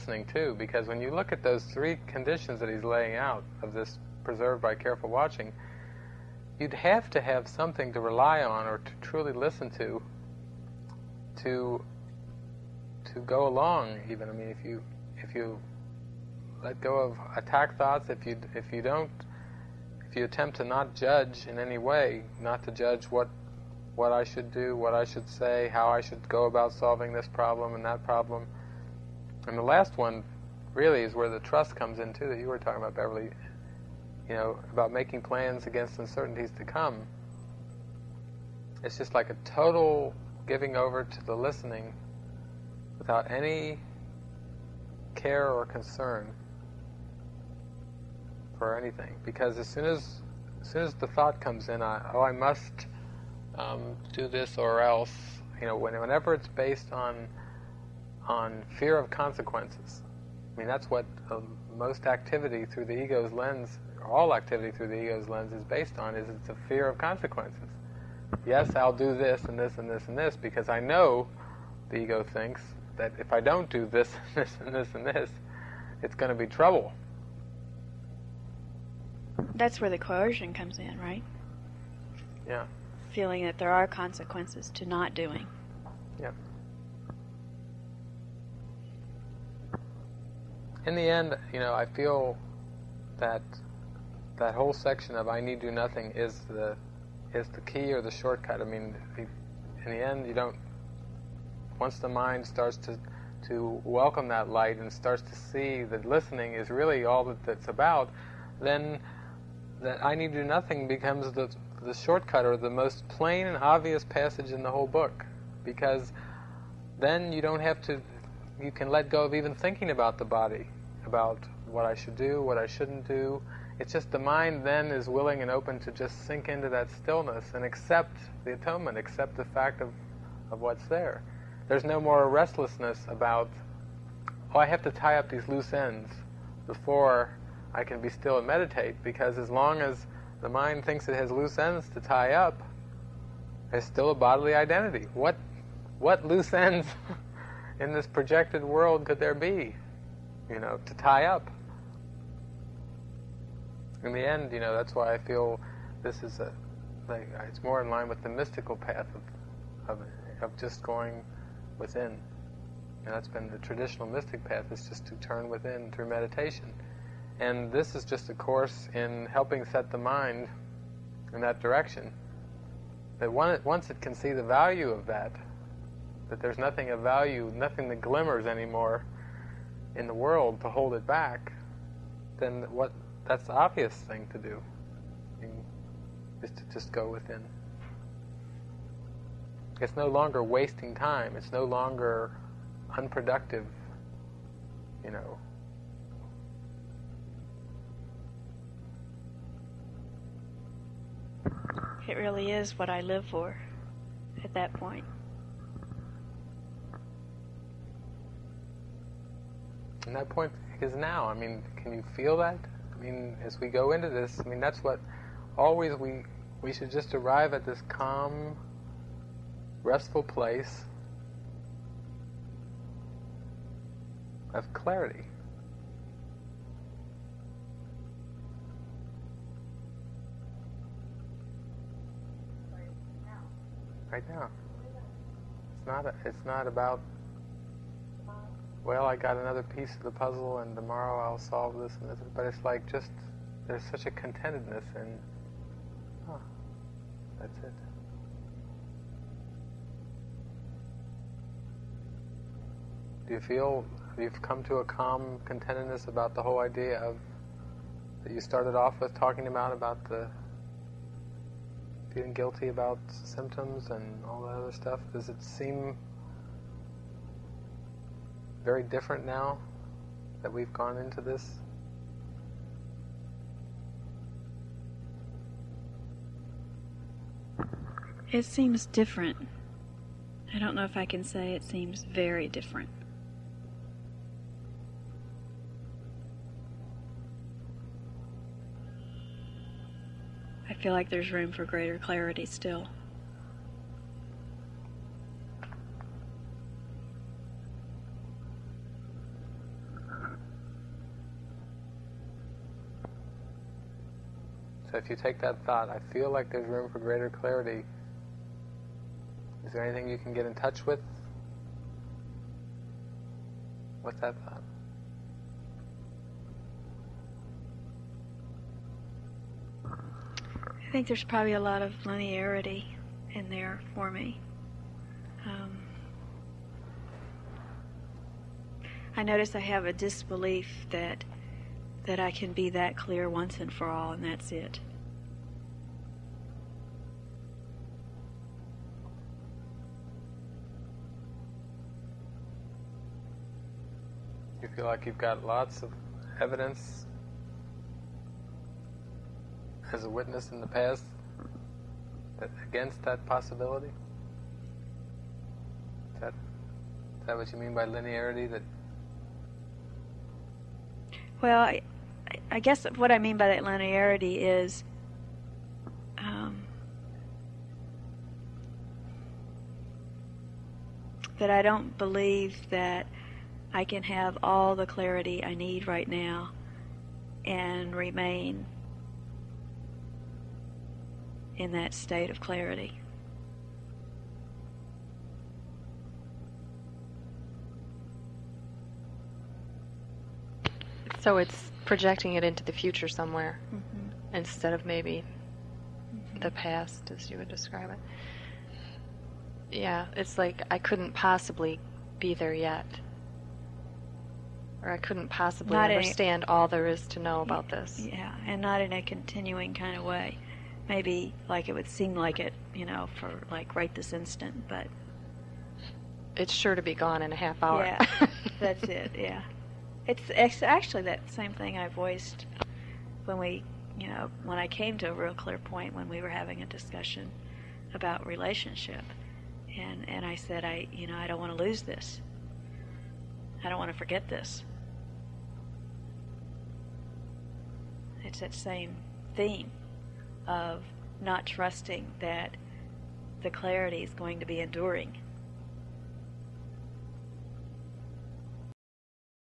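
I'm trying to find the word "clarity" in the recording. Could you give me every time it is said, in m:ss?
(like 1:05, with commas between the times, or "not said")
3:44, 4:51, 5:07, 6:14, 6:22, 7:23.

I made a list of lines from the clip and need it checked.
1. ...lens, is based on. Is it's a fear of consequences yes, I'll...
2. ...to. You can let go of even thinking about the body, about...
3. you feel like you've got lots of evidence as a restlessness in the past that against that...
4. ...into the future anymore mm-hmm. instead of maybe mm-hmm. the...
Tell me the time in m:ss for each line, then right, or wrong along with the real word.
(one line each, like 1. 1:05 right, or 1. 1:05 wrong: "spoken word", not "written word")
1. 1:05 right
2. 1:57 right
3. 5:44 wrong: "witness", not "restlessness"
4. 6:32 wrong: "somewhere", not "anymore".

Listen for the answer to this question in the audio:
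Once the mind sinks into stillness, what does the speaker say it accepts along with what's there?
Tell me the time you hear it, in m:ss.
2:08.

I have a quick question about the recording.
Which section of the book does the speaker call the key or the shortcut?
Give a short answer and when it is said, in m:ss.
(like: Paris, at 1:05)
I need do nothing, at 1:35.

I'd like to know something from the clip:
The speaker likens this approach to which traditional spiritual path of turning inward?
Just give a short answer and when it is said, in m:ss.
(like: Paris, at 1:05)
The mystical path, at 2:38.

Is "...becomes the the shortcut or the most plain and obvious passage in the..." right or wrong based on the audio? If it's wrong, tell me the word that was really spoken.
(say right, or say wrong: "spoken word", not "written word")
right.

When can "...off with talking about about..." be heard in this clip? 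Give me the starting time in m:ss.
4:18.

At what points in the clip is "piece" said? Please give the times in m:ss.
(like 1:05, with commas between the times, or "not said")
3:59.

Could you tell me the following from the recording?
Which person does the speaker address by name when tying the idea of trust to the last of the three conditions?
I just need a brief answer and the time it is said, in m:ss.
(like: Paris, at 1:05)
Beverly, at 0:32.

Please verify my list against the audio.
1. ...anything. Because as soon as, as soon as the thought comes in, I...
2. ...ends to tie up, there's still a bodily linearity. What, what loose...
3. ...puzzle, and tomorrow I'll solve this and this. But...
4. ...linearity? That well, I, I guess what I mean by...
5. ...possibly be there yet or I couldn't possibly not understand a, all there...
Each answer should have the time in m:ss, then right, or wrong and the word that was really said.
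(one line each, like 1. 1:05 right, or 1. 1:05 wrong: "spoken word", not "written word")
1. 0:48 right
2. 2:21 wrong: "identity", not "linearity"
3. 4:00 right
4. 5:57 right
5. 6:41 right.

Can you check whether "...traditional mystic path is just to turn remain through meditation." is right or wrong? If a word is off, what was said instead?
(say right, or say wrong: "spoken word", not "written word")
wrong: "within", not "remain".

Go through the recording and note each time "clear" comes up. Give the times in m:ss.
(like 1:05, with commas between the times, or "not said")
5:32, 7:05.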